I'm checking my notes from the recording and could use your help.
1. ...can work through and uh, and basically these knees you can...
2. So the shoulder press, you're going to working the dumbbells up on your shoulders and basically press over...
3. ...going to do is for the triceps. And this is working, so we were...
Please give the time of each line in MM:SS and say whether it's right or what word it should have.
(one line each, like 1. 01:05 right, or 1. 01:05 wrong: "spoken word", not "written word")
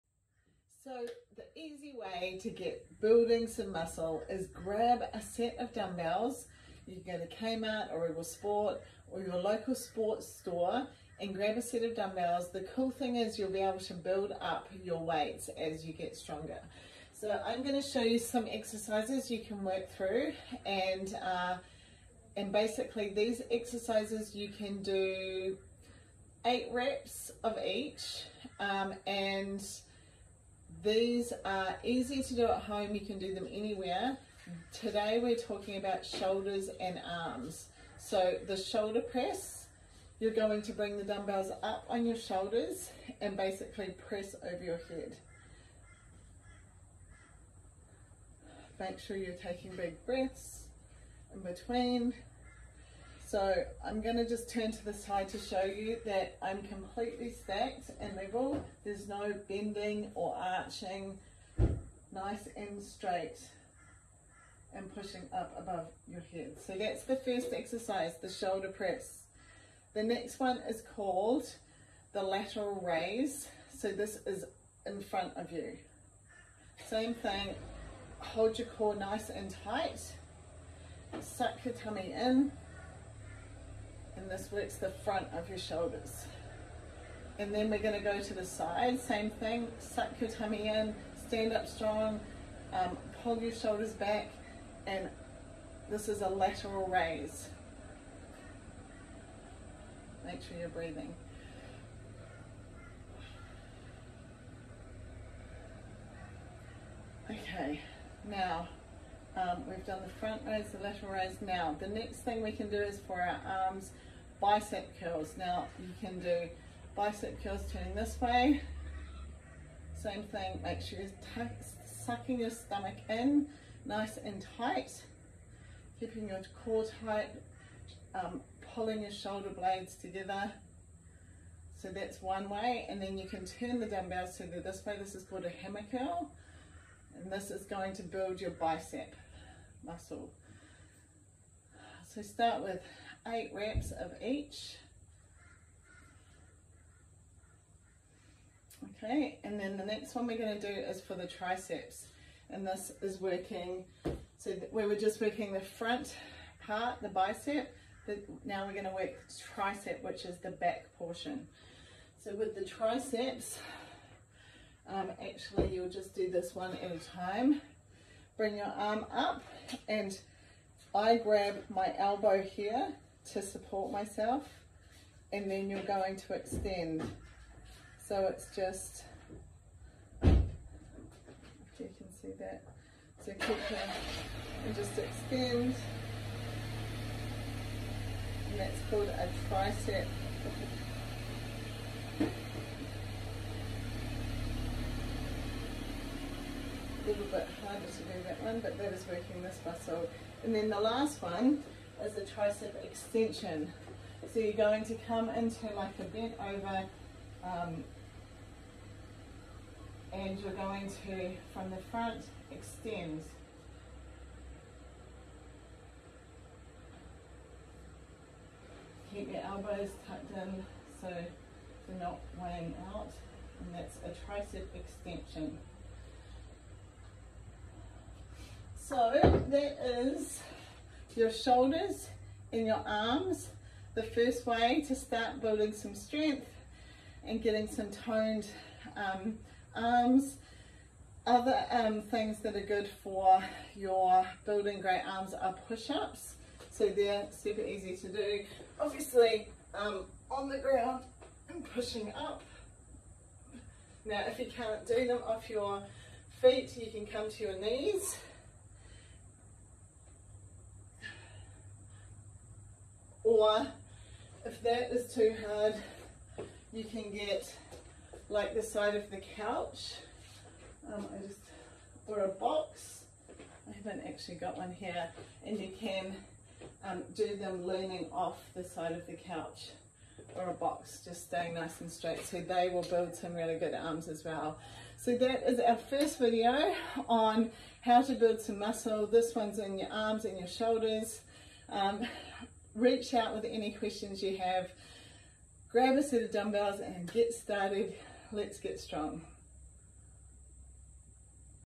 1. 00:19 wrong: "exercises", not "knees"
2. 00:37 wrong: "bring", not "working"
3. 02:30 right.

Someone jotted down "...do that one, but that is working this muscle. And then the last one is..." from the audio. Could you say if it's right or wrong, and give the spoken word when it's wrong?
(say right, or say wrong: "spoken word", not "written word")
right.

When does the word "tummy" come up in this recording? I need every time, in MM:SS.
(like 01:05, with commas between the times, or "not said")
01:21, 01:30.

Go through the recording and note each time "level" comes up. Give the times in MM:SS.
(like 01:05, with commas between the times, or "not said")
00:58.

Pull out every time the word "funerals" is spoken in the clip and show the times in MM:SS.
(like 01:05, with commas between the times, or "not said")
not said.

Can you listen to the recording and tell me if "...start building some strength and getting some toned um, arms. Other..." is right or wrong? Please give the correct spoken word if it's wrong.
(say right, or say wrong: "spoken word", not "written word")
right.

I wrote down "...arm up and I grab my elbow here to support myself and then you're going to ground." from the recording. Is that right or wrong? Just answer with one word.
wrong.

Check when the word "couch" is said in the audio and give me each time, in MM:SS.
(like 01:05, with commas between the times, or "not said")
04:29, 04:39.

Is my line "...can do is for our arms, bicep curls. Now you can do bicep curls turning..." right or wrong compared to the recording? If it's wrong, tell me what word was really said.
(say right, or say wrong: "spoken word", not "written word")
right.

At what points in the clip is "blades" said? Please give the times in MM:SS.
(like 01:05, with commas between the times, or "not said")
02:09.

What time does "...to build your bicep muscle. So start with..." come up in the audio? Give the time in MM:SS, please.
02:17.